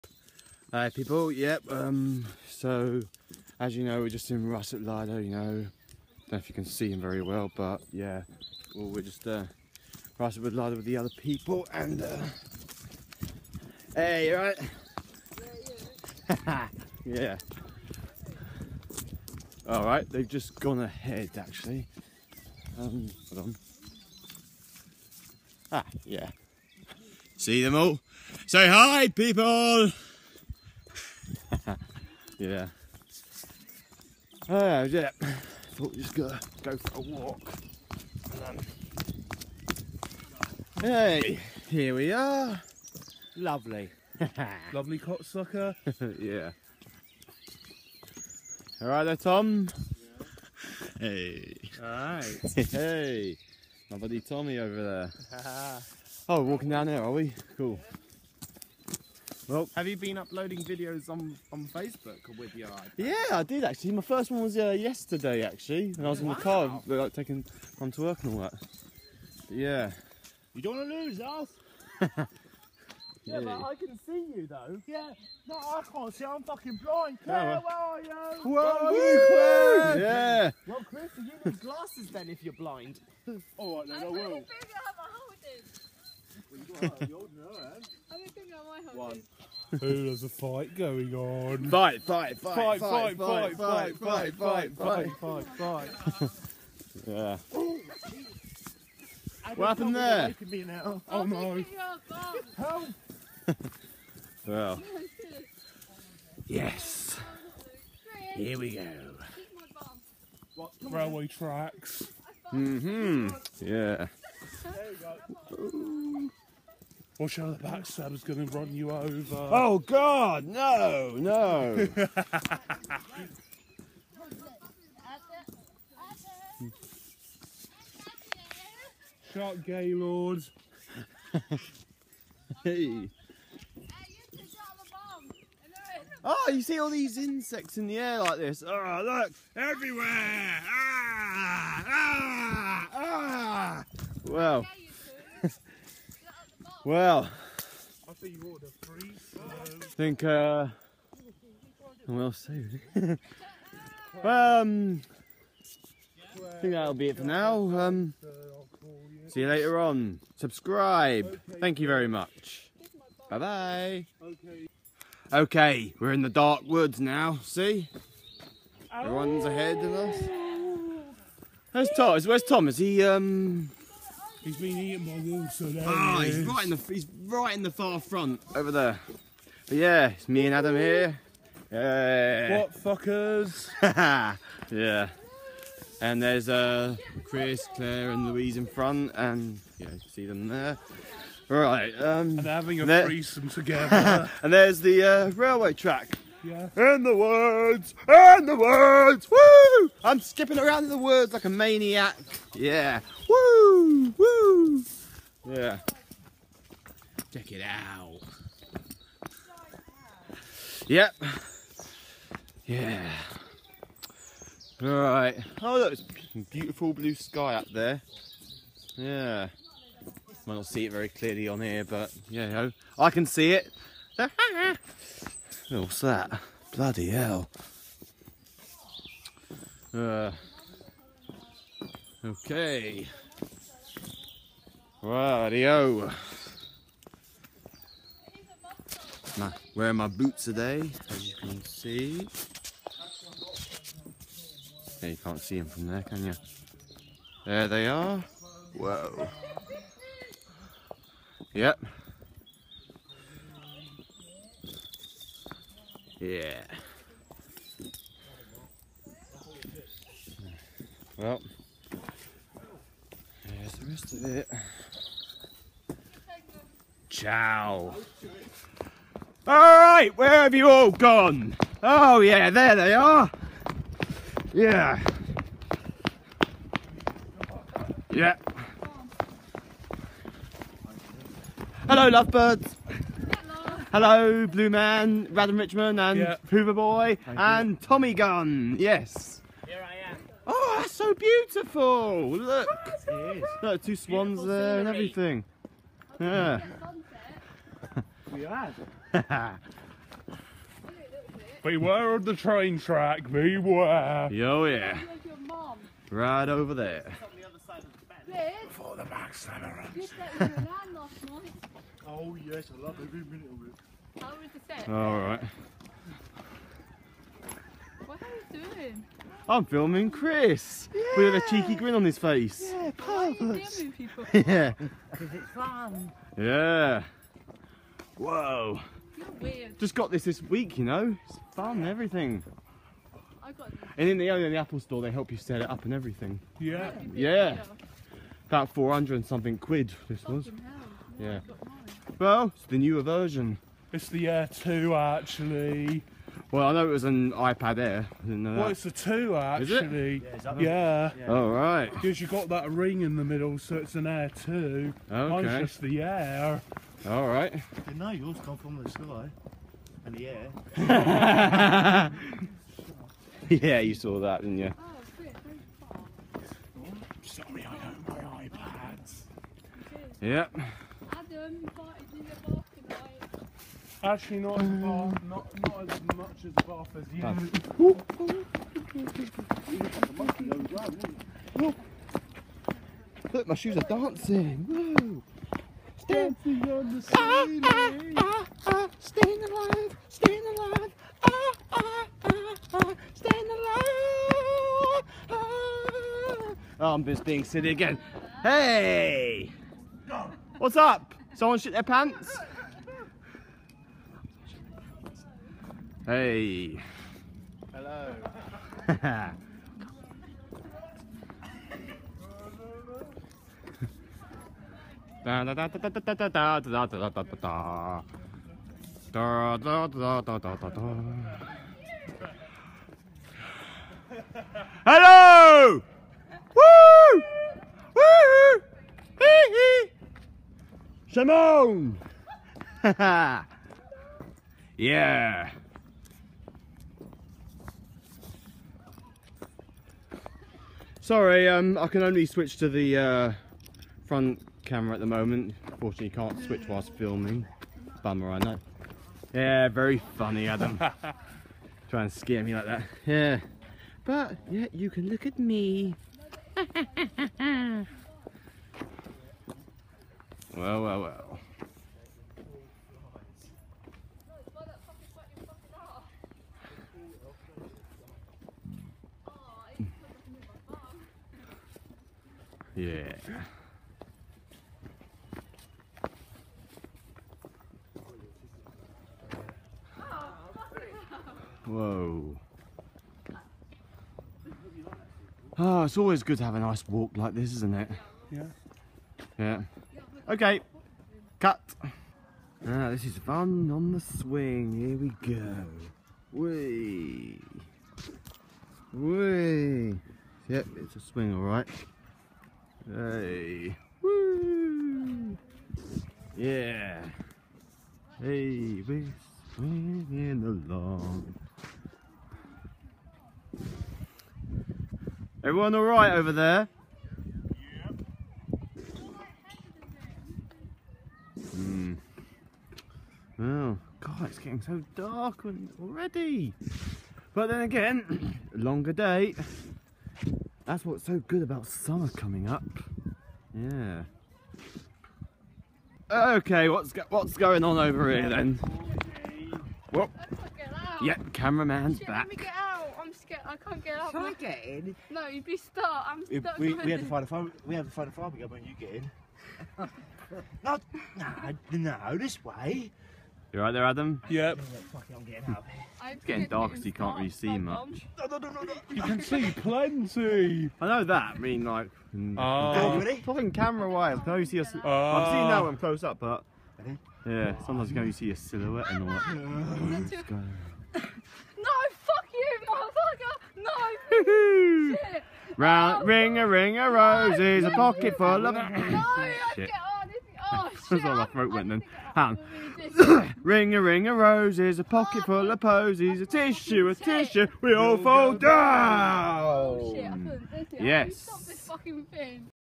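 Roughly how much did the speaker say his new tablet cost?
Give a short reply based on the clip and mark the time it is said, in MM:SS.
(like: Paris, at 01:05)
400 and something quid, at 05:38.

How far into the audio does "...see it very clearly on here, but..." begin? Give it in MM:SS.
03:40.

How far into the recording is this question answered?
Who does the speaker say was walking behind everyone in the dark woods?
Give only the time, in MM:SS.
03:00.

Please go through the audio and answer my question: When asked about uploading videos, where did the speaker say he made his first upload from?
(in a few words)
in the car.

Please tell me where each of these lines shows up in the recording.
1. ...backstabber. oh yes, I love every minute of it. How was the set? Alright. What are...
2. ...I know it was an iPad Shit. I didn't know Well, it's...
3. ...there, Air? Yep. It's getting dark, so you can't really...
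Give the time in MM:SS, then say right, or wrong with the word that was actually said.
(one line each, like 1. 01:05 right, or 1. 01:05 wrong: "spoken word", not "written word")
1. 05:09 right
2. 05:46 wrong: "Air", not "Shit"
3. 09:13 wrong: "Adam", not "Air".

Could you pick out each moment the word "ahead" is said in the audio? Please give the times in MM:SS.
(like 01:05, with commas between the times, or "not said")
00:20, 02:49.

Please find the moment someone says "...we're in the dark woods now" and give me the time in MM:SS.
02:45.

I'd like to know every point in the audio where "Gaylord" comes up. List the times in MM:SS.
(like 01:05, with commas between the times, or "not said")
02:09.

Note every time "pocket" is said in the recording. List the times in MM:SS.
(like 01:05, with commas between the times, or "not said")
09:37, 09:44.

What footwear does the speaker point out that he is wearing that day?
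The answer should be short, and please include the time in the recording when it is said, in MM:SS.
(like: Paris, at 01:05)
boots, at 04:00.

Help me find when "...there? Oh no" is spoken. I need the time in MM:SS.
01:39.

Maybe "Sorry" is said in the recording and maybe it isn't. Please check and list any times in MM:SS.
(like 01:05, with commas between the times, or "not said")
06:07, 07:21.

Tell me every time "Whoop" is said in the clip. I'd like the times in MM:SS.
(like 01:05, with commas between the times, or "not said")
08:59.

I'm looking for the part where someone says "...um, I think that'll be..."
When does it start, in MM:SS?
02:34.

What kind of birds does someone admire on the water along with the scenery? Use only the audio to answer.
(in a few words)
swans.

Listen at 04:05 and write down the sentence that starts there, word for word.
Yeah, you can't see them from there, can you?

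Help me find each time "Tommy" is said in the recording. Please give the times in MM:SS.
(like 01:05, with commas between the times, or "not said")
00:54, 04:47.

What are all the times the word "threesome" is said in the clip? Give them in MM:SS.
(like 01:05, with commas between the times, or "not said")
03:13.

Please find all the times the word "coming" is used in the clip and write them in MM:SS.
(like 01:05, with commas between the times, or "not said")
08:52.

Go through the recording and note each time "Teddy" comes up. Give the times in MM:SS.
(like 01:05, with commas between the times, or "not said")
not said.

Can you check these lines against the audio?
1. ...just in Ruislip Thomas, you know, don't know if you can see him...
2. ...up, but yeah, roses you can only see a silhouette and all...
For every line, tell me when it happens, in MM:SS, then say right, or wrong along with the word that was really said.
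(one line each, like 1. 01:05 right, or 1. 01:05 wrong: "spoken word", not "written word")
1. 00:04 wrong: "Lido", not "Thomas"
2. 09:26 wrong: "sometimes", not "roses".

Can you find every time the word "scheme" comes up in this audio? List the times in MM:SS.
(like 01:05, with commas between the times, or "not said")
not said.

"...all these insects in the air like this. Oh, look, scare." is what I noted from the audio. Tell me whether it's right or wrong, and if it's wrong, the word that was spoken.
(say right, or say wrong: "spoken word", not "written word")
wrong: "everywhere", not "scare".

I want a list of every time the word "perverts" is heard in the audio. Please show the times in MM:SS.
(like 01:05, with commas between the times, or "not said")
05:22.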